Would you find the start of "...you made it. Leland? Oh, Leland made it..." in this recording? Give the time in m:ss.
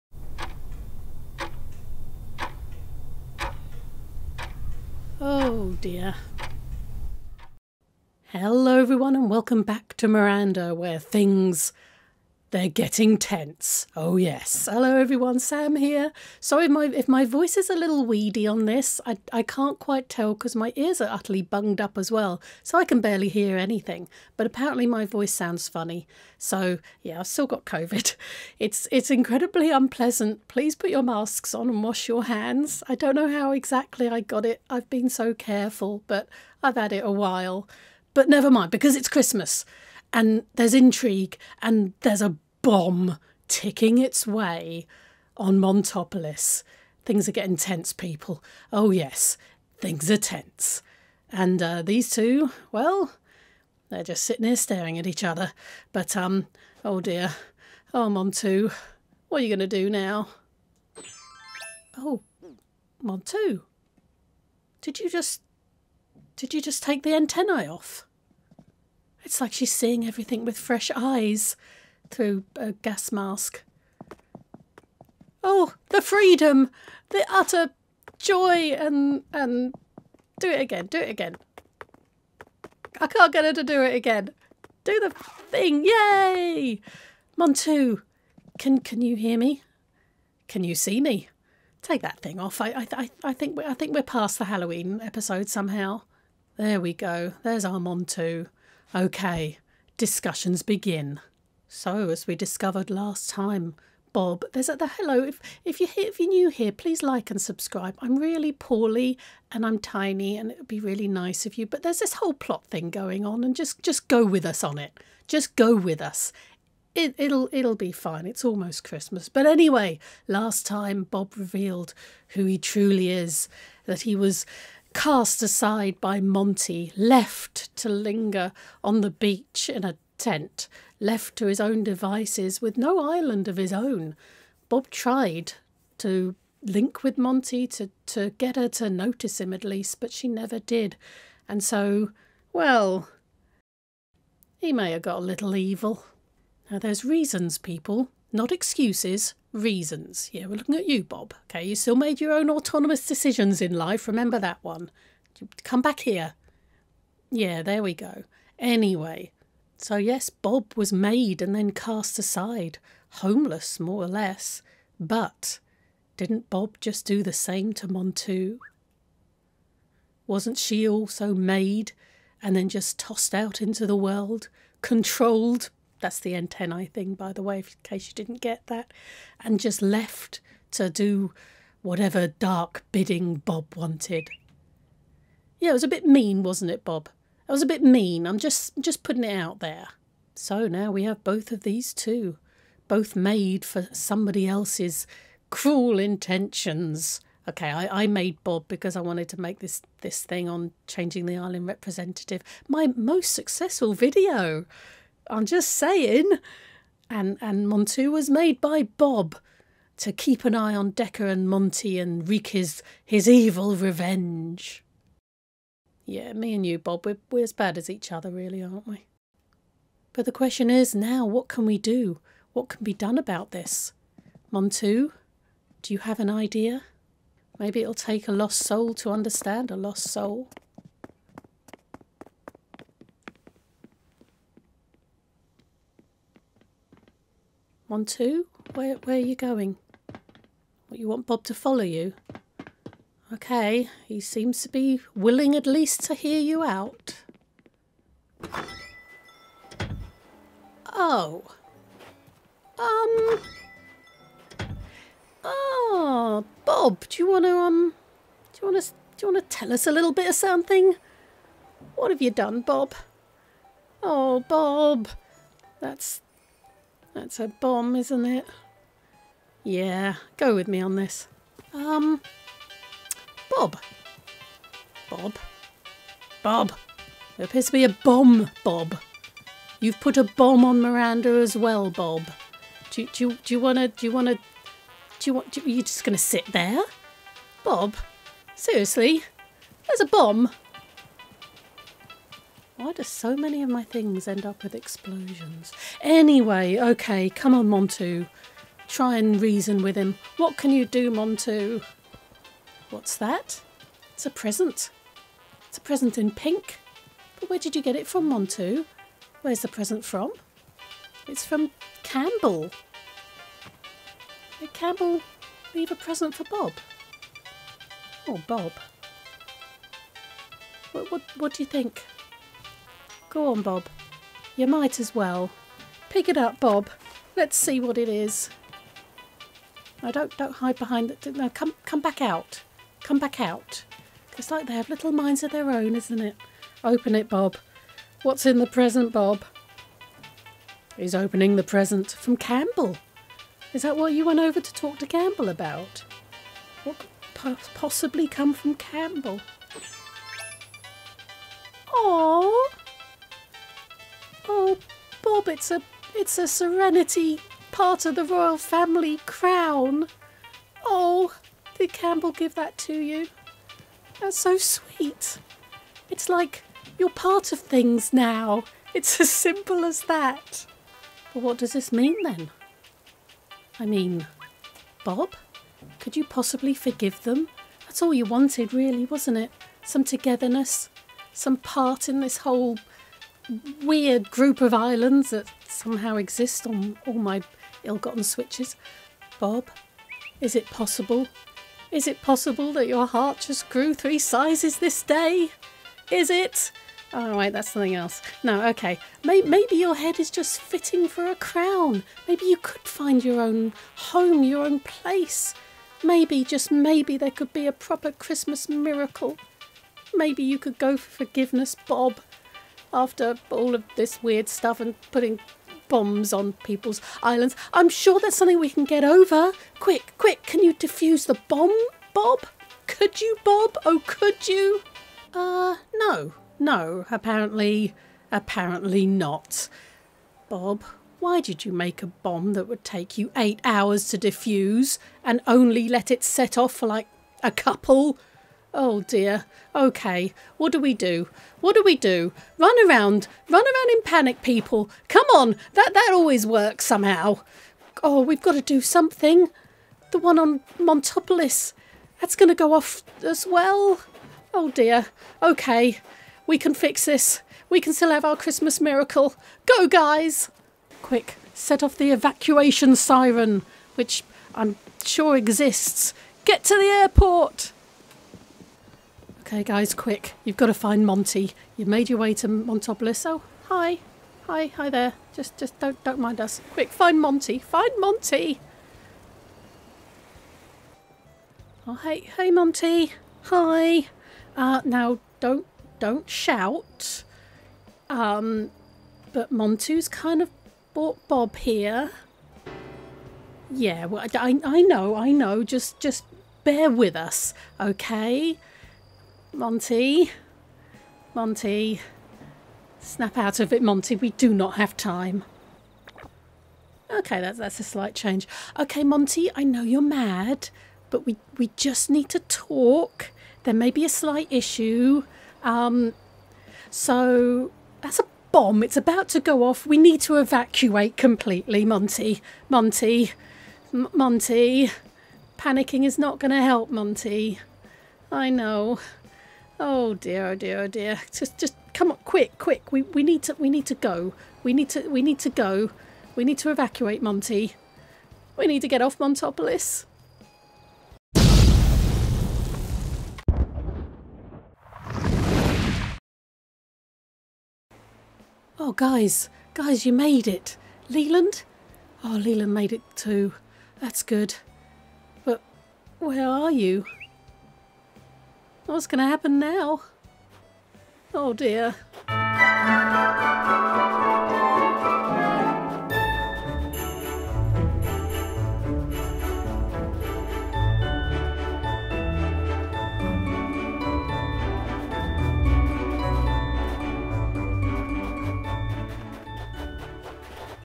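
9:10.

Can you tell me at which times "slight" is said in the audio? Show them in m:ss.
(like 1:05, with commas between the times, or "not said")
8:27, 8:34.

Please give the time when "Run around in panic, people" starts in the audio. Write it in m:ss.
7:23.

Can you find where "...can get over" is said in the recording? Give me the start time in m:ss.
6:58.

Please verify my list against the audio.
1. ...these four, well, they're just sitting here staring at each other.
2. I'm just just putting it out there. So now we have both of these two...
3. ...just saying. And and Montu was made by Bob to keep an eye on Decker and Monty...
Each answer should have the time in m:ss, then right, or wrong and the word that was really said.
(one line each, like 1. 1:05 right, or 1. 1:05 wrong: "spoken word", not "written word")
1. 0:51 wrong: "two", not "four"
2. 3:08 right
3. 3:25 right.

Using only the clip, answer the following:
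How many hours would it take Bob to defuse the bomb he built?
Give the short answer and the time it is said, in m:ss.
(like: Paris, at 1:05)
8, at 7:13.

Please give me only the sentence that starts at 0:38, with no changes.
But never mind, because it's Christmas and there's intrigue and there's a bomb ticking its way on Montopolis.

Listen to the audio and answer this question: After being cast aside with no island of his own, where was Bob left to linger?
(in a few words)
On the beach in a tent.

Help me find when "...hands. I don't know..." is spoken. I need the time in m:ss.
0:32.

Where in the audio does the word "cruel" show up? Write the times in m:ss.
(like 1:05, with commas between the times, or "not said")
3:15.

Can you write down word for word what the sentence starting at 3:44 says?
Montu, do you have an idea?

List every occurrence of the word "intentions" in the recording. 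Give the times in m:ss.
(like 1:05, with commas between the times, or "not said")
3:15.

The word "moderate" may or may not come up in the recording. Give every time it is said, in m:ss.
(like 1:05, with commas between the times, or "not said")
not said.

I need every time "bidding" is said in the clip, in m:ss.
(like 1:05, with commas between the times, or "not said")
3:02.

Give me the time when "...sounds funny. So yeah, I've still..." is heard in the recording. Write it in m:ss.
0:25.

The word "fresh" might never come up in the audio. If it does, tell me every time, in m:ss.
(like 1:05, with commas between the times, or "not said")
1:10.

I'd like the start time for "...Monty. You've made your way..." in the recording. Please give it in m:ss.
7:51.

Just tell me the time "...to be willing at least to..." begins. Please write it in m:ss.
4:04.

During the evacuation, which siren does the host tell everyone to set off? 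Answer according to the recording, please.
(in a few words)
Evacuation siren.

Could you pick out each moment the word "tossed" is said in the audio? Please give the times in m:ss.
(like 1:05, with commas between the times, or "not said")
2:52.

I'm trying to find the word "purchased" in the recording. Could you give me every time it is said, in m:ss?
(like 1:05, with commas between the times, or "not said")
not said.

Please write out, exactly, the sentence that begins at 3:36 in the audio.
Yeah, me and you, Bob, we're, we're as bad as each other, really, aren't we?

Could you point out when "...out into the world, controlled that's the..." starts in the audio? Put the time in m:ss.
2:53.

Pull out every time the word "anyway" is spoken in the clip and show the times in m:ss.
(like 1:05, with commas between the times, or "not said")
1:59, 2:38, 4:56.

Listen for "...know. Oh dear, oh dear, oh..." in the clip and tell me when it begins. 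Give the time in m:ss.
8:48.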